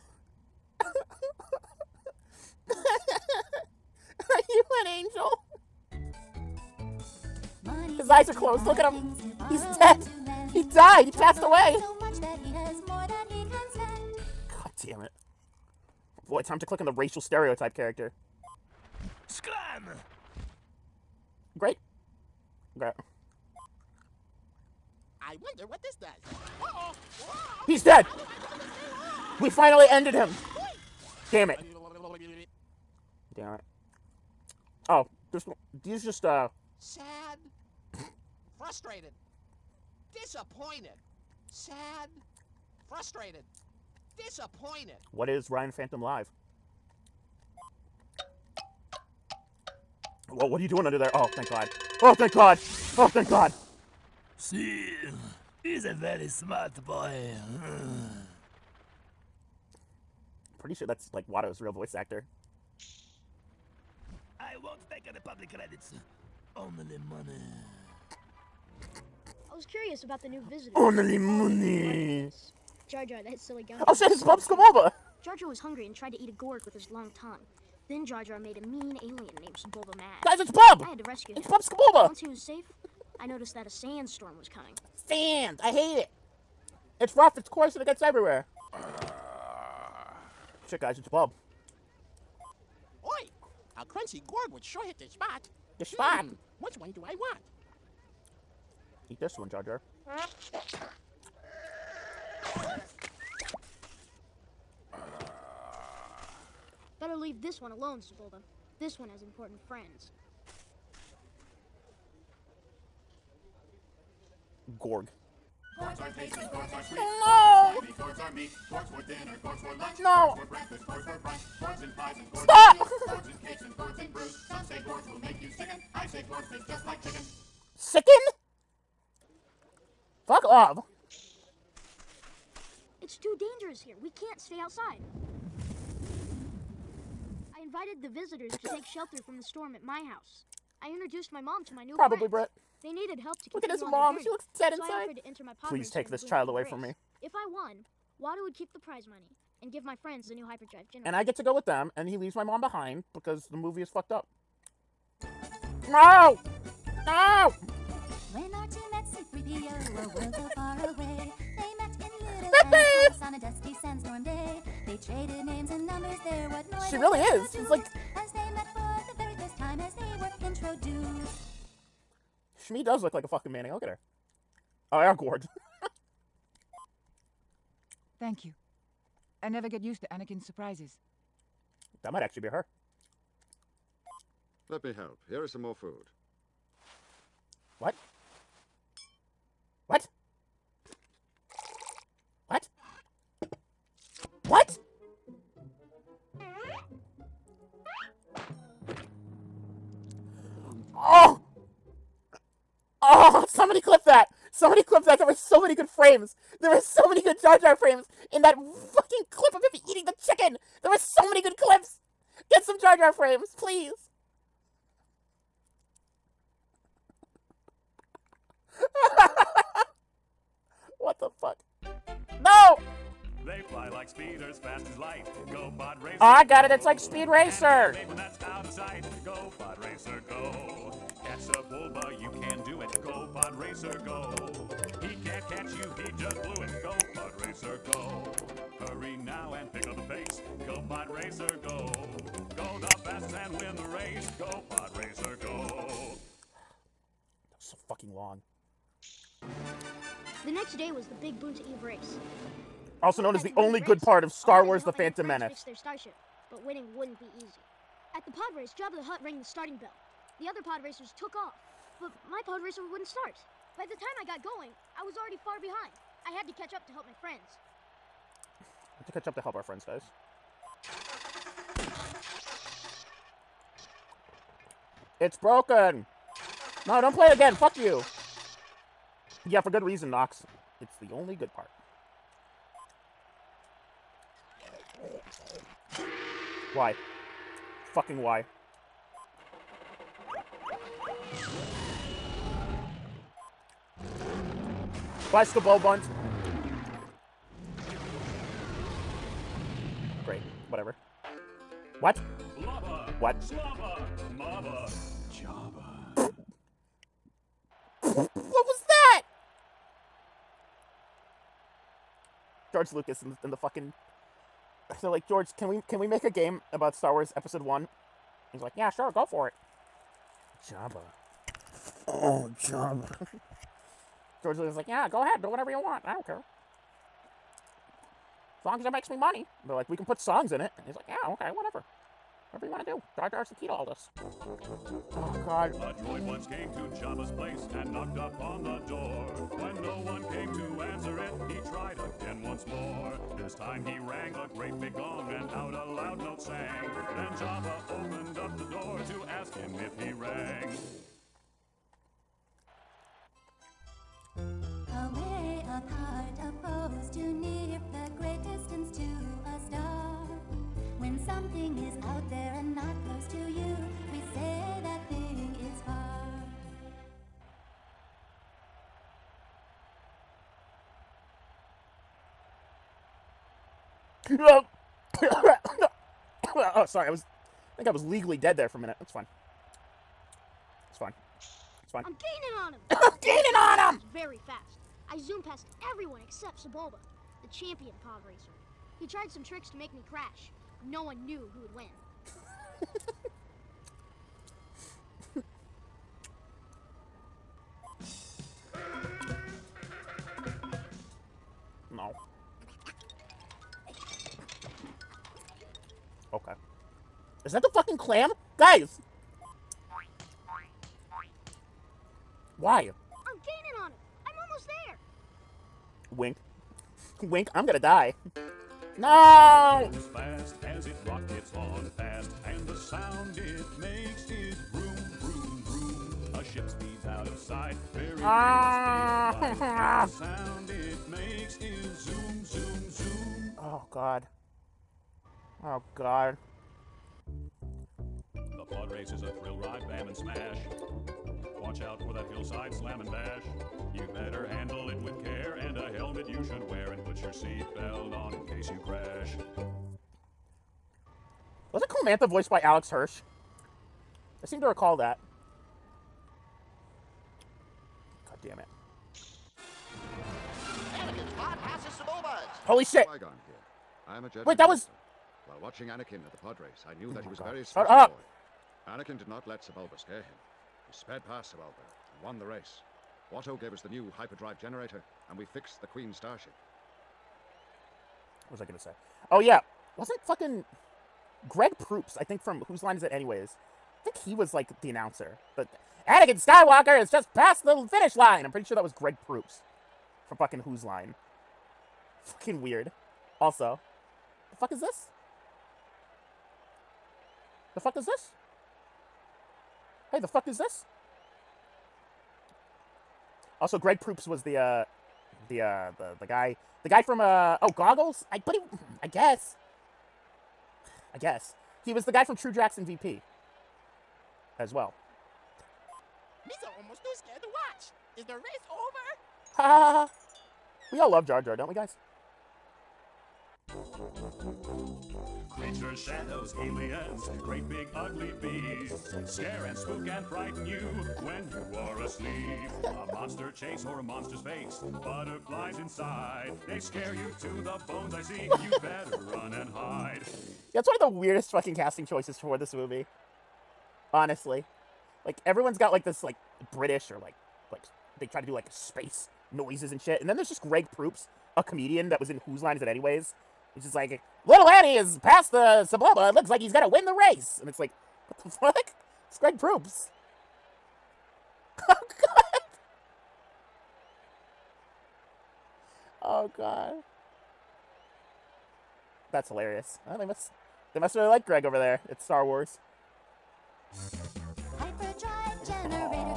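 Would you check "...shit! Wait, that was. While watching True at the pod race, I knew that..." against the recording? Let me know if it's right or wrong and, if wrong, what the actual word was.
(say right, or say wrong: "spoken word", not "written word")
wrong: "Anakin", not "True".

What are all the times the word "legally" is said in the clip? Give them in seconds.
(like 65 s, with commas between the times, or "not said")
378 s.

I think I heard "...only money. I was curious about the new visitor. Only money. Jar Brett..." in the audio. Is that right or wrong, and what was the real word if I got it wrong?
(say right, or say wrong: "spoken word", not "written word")
wrong: "Jar", not "Brett".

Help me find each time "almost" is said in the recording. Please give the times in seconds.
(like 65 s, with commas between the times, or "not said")
414 s, 516 s.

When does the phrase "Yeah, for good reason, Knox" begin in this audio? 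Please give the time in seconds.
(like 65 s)
279 s.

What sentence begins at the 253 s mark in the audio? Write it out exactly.
Also known as the only race, good part of Star Wars The Phantom Menace.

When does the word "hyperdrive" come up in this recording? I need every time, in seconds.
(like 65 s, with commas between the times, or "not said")
150 s, 474 s.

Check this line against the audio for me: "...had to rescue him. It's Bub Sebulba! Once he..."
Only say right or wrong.
right.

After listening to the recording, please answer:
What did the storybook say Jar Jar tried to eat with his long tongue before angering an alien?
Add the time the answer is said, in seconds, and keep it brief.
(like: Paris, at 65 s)
A gourd, at 76 s.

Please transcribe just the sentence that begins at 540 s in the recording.
That's one of the weirdest fucking casting choices for this movie.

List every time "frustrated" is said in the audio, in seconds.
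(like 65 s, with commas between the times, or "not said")
38 s, 42 s.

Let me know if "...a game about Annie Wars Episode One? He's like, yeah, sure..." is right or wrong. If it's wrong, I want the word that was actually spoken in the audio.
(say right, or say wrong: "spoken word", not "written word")
wrong: "Star", not "Annie".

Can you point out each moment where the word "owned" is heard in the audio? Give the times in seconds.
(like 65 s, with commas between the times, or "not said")
not said.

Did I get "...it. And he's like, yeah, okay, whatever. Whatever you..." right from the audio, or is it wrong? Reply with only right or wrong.
right.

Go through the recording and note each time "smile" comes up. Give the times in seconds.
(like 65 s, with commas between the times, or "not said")
not said.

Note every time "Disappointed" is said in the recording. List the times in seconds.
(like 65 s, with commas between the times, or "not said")
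40 s, 44 s.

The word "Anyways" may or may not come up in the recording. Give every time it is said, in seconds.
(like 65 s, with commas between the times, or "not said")
483 s, 552 s.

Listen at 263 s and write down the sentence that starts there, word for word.
By the time I got going, I was already far behind.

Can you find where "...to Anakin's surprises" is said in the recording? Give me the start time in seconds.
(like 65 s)
180 s.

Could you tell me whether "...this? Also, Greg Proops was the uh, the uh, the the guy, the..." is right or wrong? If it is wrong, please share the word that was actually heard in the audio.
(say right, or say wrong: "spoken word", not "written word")
right.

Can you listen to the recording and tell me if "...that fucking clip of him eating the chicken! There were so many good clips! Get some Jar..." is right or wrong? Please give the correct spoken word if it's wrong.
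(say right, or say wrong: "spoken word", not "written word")
right.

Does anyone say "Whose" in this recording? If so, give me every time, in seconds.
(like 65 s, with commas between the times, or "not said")
482 s, 490 s, 552 s.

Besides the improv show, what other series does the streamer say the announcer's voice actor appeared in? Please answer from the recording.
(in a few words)
True Jackson VP.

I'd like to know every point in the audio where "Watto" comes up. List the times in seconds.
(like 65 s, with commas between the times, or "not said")
61 s, 148 s, 473 s.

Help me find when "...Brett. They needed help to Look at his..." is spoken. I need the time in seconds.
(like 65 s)
142 s.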